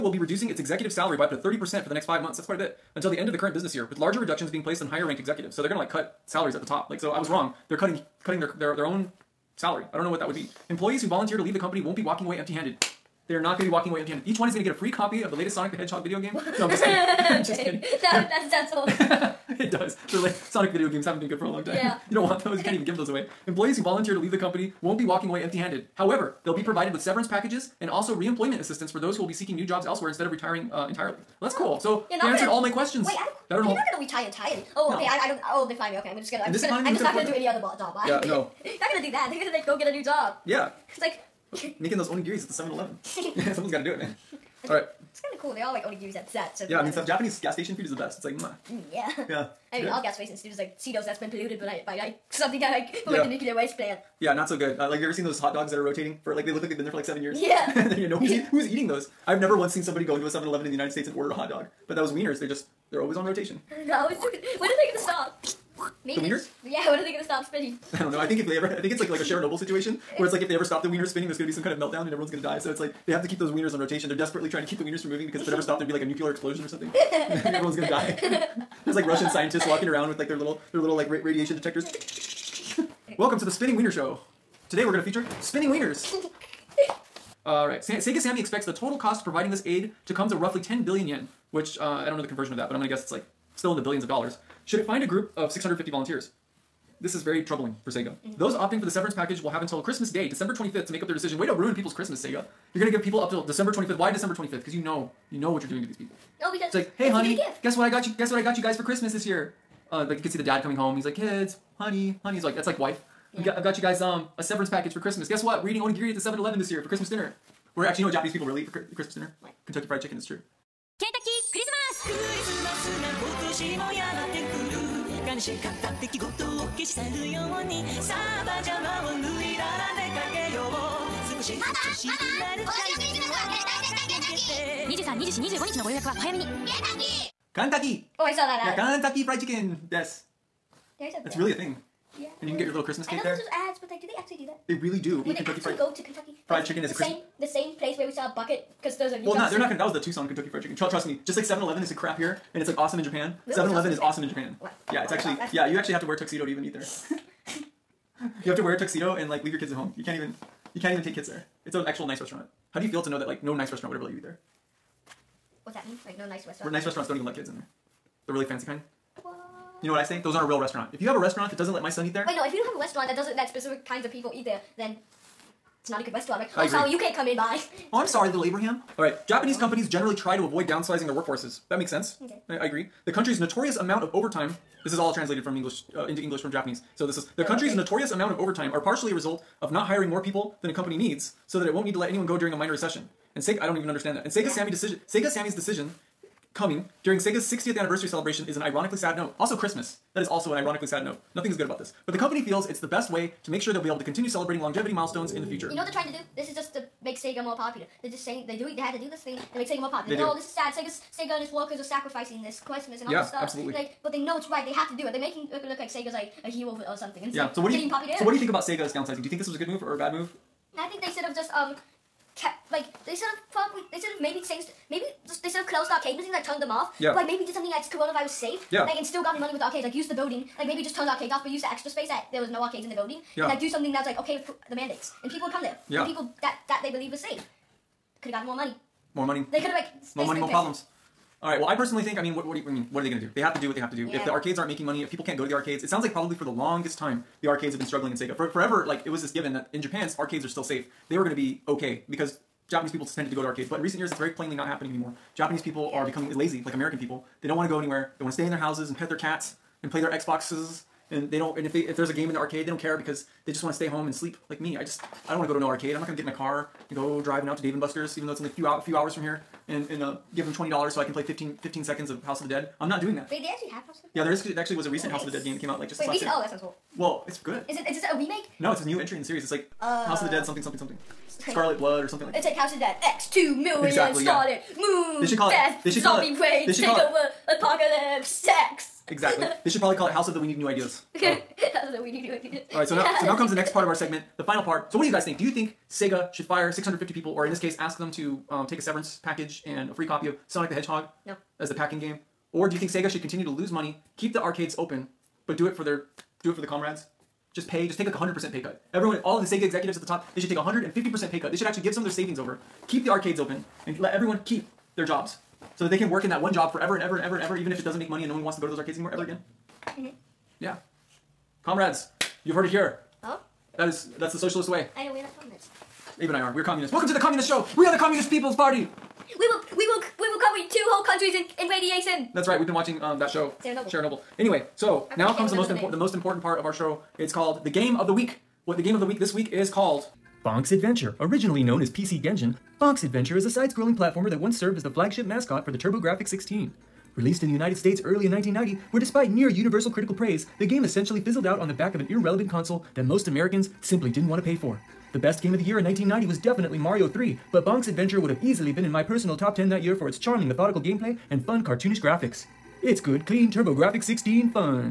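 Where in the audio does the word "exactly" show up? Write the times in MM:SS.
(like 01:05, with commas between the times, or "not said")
04:43, 04:49.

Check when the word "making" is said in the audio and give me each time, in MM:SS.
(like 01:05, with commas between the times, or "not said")
00:41, 03:35, 04:04.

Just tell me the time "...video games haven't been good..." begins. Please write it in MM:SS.
00:20.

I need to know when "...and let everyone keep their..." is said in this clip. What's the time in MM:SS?
05:13.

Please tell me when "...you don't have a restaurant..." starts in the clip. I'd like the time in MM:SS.
02:52.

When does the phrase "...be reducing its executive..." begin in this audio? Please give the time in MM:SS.
00:00.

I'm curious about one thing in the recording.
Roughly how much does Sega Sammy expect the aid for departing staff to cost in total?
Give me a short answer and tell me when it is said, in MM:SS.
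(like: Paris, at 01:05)
10 billion yen, at 01:30.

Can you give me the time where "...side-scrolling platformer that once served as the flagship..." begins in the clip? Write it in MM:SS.
05:43.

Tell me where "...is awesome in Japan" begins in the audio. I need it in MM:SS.
02:33.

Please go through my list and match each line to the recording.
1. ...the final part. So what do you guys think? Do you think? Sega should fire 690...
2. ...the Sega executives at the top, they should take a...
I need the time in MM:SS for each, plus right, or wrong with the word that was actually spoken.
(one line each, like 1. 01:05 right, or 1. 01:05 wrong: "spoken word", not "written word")
1. 04:54 wrong: "650", not "690"
2. 05:09 right.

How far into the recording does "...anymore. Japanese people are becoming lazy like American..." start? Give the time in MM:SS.
04:14.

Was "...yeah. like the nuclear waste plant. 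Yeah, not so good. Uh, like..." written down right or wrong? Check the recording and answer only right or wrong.
right.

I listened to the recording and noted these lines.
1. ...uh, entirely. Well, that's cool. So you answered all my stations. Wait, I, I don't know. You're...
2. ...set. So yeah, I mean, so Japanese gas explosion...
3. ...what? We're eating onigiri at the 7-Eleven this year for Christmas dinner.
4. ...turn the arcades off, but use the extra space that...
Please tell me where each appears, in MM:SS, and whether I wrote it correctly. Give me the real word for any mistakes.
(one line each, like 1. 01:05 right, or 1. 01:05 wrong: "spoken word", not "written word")
1. 00:30 wrong: "questions", not "stations"
2. 00:46 wrong: "station", not "explosion"
3. 01:55 right
4. 03:50 right.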